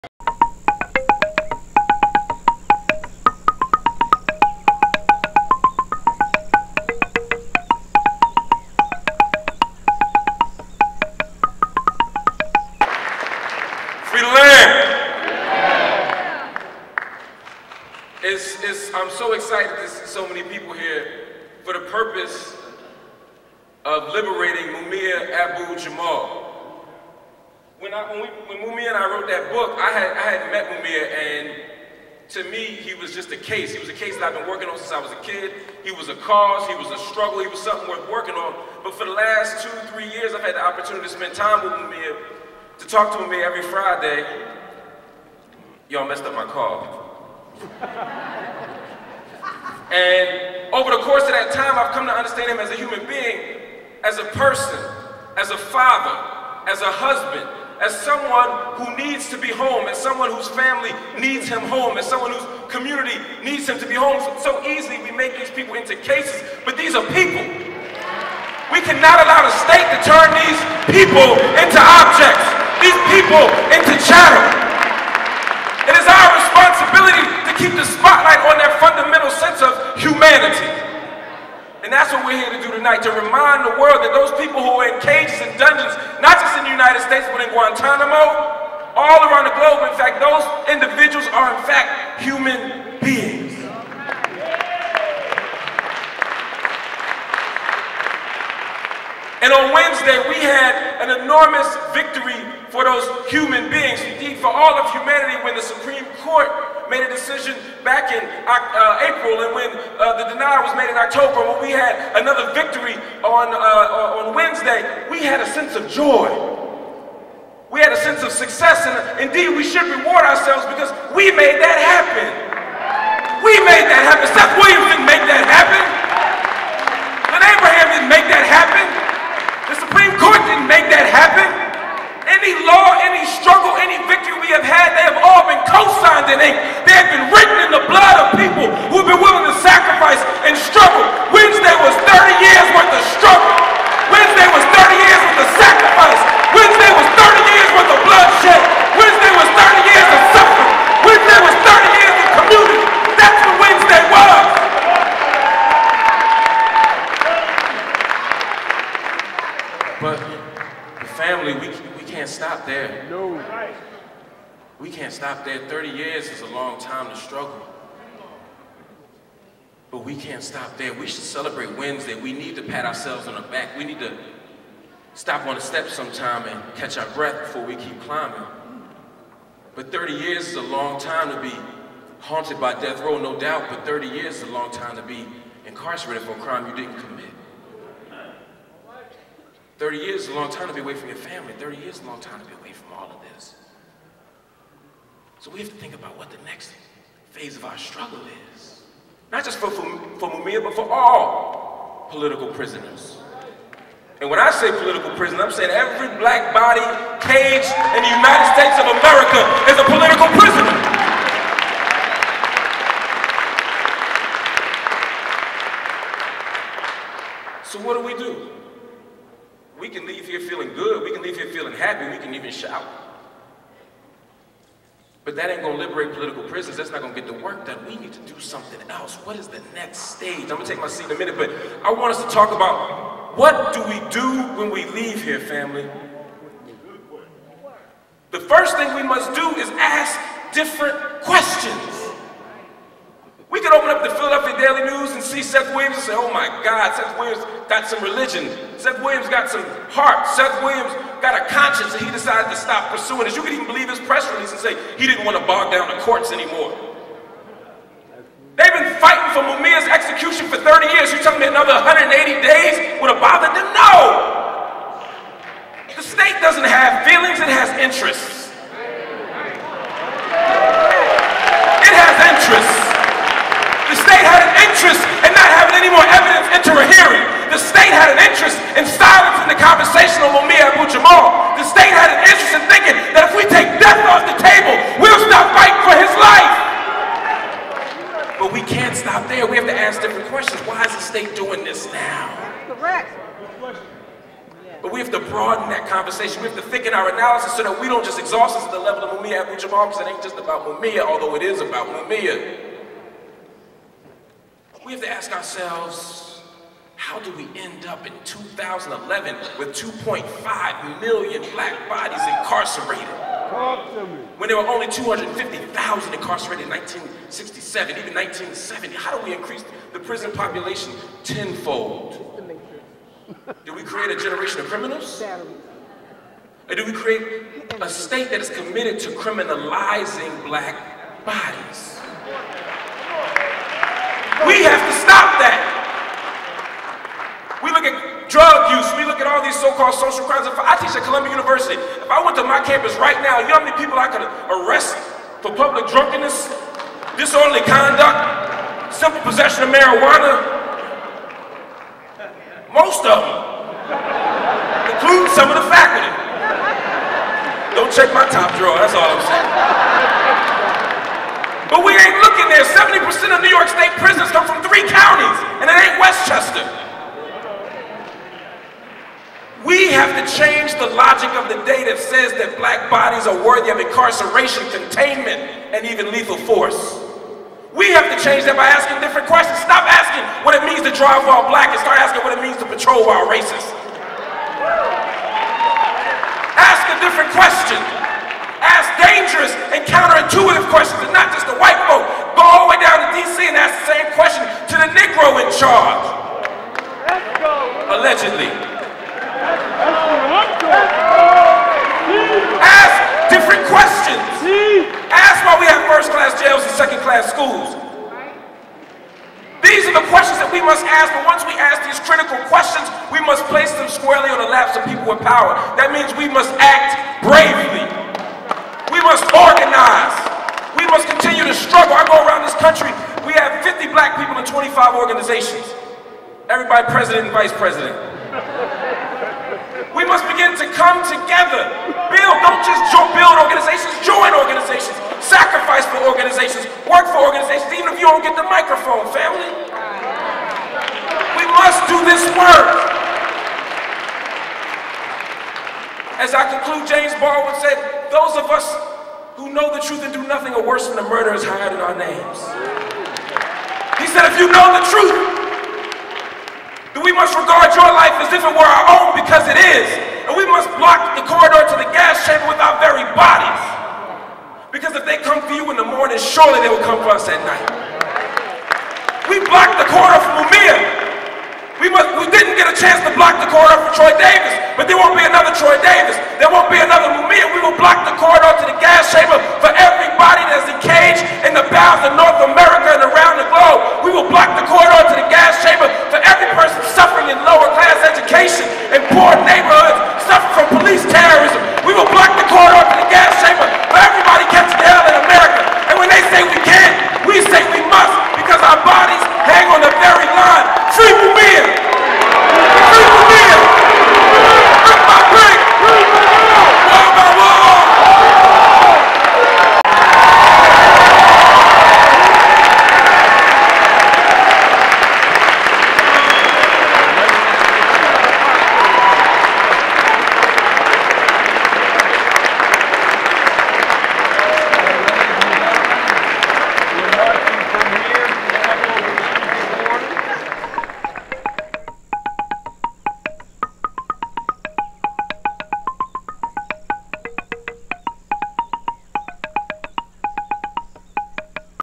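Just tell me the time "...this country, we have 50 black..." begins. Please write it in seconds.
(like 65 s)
422 s.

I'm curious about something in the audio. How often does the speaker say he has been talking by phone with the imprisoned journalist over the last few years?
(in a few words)
Every Friday.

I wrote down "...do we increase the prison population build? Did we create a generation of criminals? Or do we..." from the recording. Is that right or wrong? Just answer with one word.
wrong.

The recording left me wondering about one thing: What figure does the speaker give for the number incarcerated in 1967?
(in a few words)
250,000.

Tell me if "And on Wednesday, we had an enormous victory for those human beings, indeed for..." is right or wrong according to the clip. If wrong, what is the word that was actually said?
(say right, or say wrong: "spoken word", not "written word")
right.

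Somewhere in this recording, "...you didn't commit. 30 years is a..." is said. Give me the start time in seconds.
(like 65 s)
186 s.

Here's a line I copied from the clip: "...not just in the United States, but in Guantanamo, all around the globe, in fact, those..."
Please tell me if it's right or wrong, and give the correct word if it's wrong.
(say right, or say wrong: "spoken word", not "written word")
right.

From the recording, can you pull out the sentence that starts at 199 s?
Not just for, for, for Mumia, but for all political prisoners.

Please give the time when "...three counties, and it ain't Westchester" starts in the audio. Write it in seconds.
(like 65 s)
364 s.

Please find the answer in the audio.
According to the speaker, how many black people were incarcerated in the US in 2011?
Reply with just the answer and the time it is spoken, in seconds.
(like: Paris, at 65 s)
2.5 million, at 309 s.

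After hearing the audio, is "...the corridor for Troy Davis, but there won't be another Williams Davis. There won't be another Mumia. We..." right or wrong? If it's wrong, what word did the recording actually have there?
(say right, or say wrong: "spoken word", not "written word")
wrong: "Troy", not "Williams".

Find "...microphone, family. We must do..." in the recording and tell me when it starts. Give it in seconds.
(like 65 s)
438 s.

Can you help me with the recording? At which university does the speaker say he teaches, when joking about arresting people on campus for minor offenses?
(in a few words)
Columbia University.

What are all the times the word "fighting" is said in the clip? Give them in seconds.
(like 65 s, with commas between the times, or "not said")
259 s, 285 s.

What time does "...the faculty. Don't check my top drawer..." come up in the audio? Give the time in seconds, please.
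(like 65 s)
355 s.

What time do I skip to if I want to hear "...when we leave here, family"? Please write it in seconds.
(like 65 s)
234 s.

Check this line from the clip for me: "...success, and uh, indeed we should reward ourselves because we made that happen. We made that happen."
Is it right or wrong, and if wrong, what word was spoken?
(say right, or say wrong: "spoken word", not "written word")
right.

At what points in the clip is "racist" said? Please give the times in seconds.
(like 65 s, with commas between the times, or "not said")
383 s.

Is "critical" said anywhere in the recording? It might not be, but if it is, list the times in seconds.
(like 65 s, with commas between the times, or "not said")
412 s.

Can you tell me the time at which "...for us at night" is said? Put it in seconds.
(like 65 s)
467 s.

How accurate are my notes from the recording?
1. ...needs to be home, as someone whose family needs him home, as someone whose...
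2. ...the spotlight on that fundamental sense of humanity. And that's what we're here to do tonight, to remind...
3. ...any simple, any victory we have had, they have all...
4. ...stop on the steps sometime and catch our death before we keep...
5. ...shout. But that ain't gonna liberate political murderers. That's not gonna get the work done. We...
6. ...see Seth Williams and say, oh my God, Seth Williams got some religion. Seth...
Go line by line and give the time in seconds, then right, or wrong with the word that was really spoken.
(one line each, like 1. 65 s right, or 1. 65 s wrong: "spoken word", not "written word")
1. 58 s right
2. 77 s right
3. 132 s wrong: "struggle", not "simple"
4. 175 s wrong: "breath", not "death"
5. 222 s wrong: "prisoners", not "murderers"
6. 245 s right.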